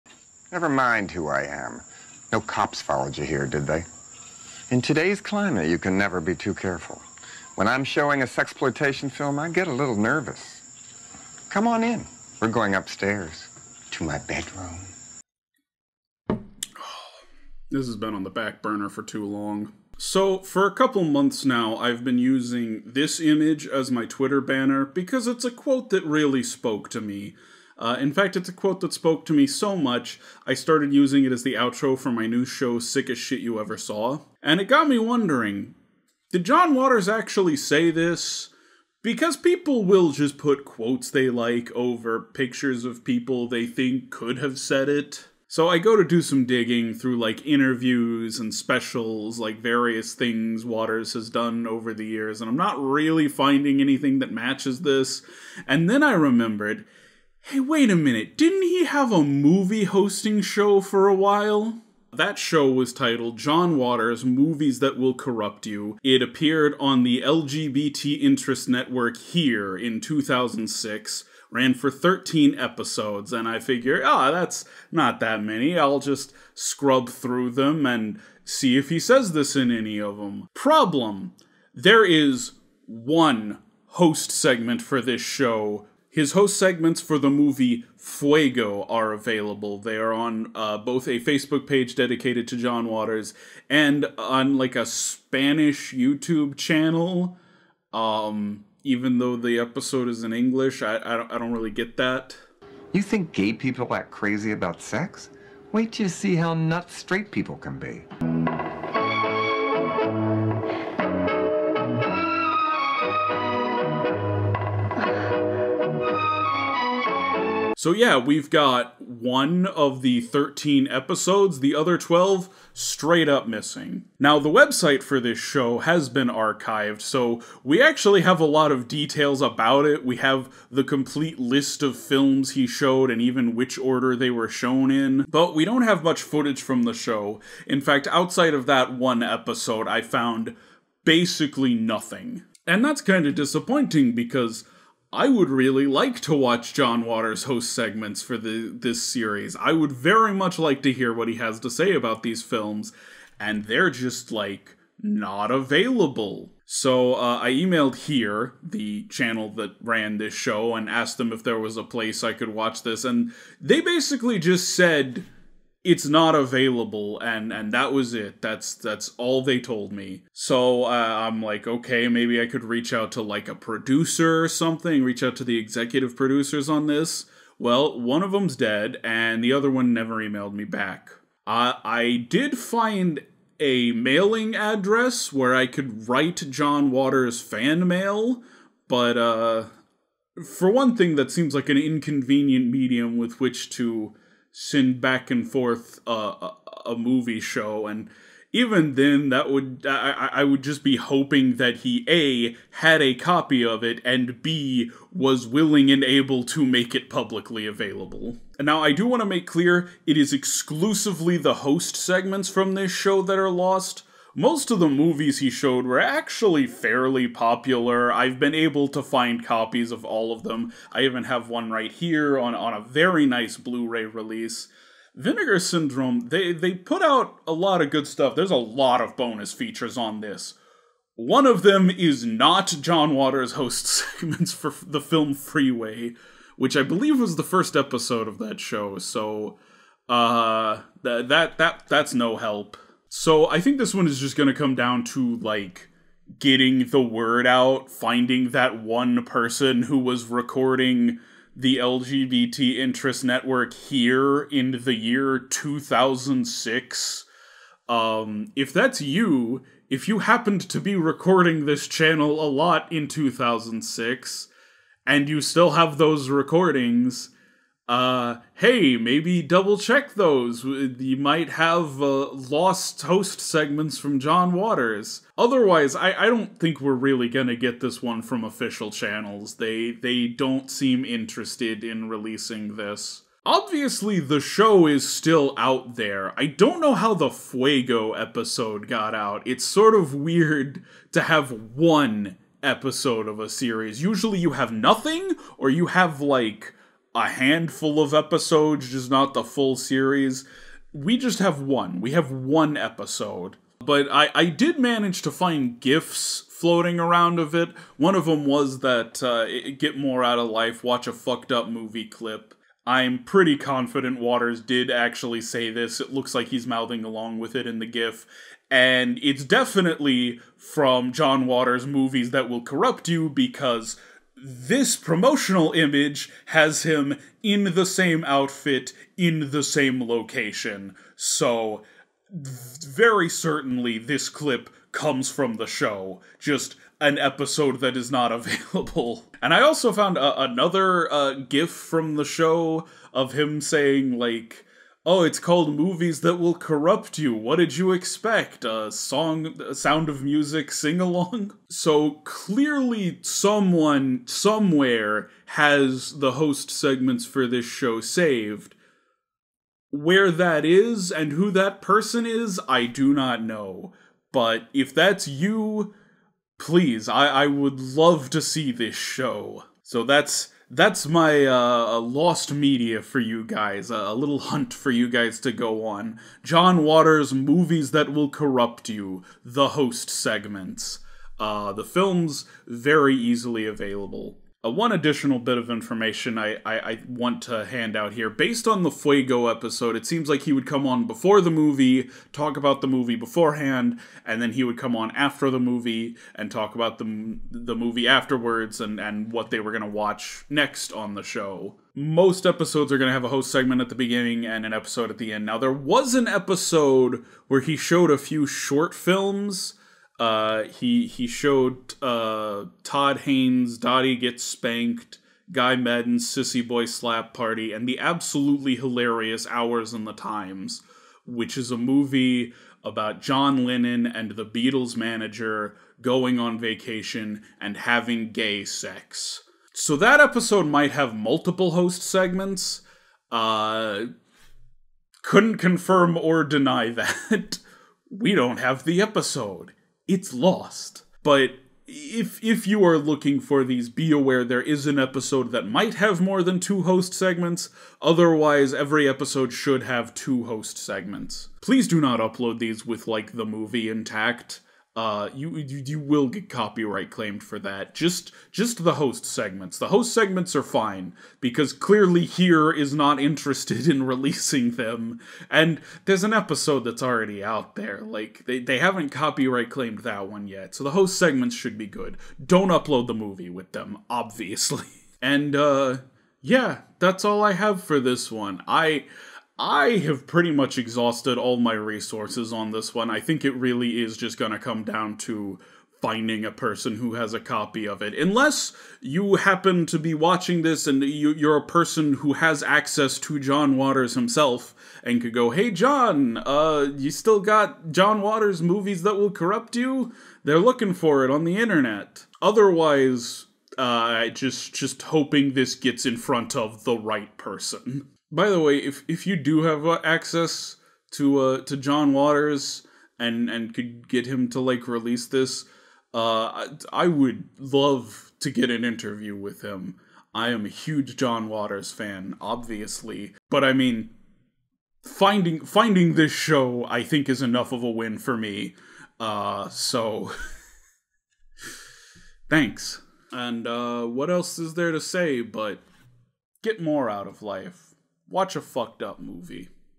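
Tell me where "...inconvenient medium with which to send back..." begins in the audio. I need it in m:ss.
3:11.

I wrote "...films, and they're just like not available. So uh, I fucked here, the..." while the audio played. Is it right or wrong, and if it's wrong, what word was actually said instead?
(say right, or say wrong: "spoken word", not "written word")
wrong: "emailed", not "fucked".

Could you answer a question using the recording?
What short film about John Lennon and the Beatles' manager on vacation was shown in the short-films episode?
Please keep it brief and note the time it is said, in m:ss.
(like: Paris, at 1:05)
Hours in the Times, at 6:59.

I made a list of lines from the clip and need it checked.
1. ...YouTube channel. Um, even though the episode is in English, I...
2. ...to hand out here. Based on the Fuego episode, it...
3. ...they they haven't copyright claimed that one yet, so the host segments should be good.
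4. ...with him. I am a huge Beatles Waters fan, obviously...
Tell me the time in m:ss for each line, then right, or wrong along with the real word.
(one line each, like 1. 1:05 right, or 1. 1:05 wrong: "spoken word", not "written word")
1. 1:35 right
2. 6:27 right
3. 7:48 right
4. 8:39 wrong: "John", not "Beatles".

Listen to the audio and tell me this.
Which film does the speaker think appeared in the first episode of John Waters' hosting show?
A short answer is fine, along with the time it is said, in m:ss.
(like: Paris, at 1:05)
Freeway, at 3:55.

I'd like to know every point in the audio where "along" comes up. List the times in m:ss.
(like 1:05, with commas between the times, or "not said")
5:17, 5:50.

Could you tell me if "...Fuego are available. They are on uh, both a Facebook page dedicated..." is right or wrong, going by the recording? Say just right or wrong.
right.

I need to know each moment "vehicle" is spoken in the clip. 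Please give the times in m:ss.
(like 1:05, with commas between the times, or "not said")
not said.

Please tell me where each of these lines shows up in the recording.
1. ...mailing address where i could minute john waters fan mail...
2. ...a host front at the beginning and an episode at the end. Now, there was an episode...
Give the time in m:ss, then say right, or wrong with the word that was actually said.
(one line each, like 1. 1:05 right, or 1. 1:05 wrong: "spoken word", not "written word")
1. 3:03 wrong: "write", not "minute"
2. 6:43 wrong: "segment", not "front".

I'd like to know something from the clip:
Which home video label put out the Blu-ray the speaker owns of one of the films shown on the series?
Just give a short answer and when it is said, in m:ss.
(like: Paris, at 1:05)
Vinegar Syndrome, at 3:45.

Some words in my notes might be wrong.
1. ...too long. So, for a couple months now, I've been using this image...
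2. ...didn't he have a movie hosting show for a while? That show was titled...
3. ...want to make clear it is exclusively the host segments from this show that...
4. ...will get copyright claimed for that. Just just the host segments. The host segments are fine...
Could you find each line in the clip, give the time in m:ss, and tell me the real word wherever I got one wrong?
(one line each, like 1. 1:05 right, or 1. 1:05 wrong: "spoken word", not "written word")
1. 0:19 right
2. 0:58 right
3. 3:29 right
4. 7:35 right.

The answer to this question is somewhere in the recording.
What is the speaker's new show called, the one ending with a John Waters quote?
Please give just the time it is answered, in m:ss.
0:32.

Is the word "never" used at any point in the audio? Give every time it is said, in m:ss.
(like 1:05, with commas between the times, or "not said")
0:00, 0:05, 2:59.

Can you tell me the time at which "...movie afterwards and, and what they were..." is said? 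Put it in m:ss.
6:37.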